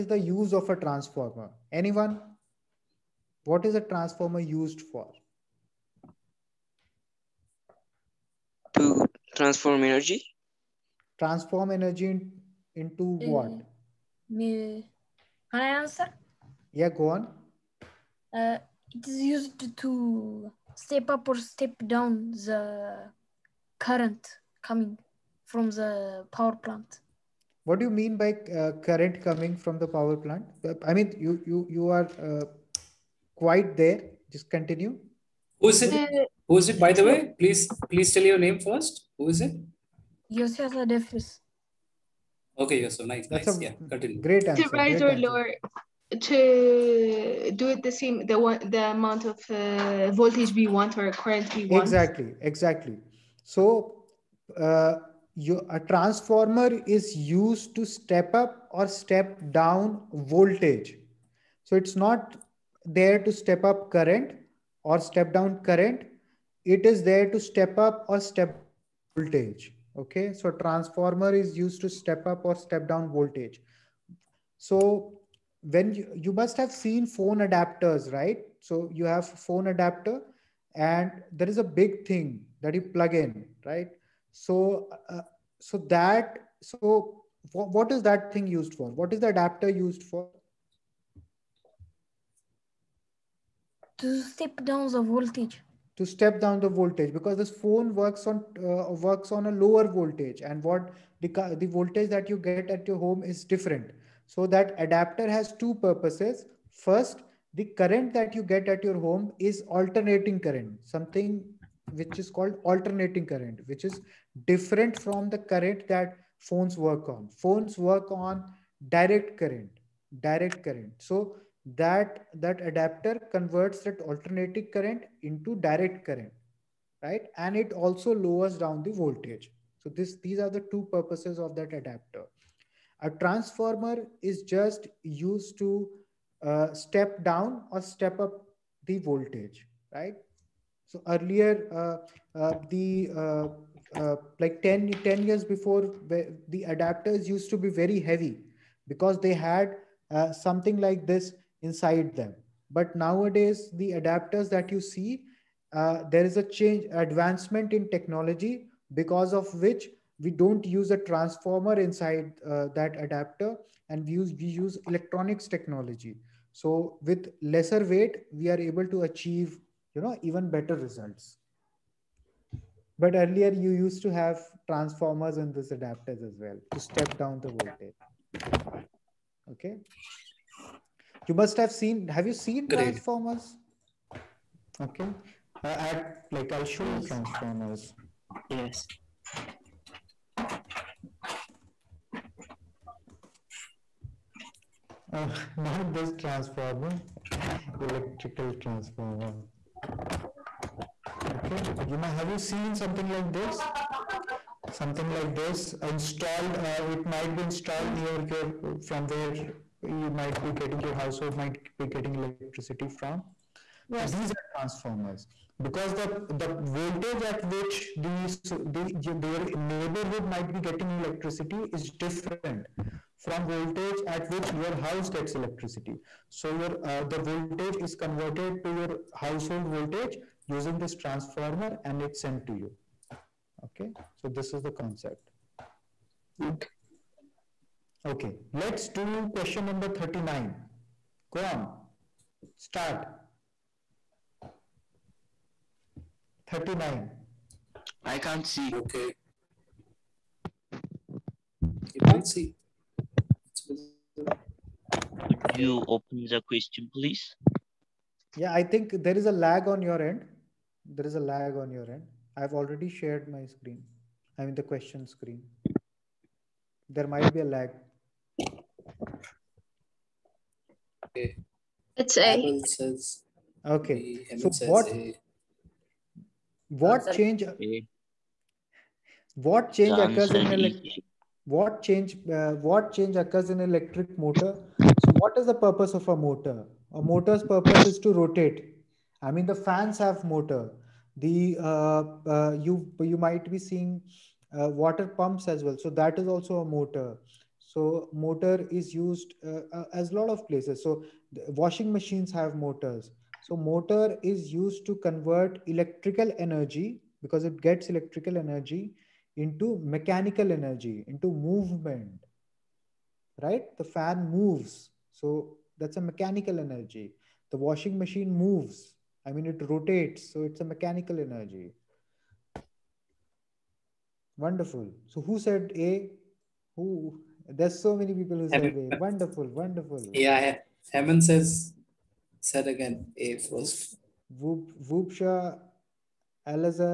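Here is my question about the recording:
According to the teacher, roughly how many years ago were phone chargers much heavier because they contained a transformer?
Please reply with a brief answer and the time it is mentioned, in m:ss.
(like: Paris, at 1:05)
10, at 2:25.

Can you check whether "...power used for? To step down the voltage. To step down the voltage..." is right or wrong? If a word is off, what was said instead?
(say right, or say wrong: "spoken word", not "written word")
wrong: "adapter", not "power".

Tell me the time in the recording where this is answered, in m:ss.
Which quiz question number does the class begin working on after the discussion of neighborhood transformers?
3:59.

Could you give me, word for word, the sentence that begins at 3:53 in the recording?
Okay, so this is the concept.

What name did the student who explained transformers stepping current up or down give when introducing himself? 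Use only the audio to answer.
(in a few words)
Yosef Adefis.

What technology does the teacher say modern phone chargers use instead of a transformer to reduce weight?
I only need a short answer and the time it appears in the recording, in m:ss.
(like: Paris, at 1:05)
Electronics technology, at 2:44.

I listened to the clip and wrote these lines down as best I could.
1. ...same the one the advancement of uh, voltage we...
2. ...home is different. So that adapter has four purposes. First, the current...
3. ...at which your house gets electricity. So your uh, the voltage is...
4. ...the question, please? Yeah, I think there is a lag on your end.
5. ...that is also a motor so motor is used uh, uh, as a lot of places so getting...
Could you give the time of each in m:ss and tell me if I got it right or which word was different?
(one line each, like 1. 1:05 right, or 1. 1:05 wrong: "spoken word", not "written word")
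1. 0:47 wrong: "amount", not "advancement"
2. 1:42 wrong: "two", not "four"
3. 3:44 right
4. 4:16 right
5. 4:55 wrong: "washing", not "getting".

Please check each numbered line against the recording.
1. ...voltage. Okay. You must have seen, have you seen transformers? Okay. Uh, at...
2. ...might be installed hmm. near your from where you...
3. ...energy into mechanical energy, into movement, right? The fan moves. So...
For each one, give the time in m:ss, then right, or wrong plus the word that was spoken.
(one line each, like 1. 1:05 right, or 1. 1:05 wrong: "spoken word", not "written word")
1. 2:57 right
2. 3:27 right
3. 5:08 right.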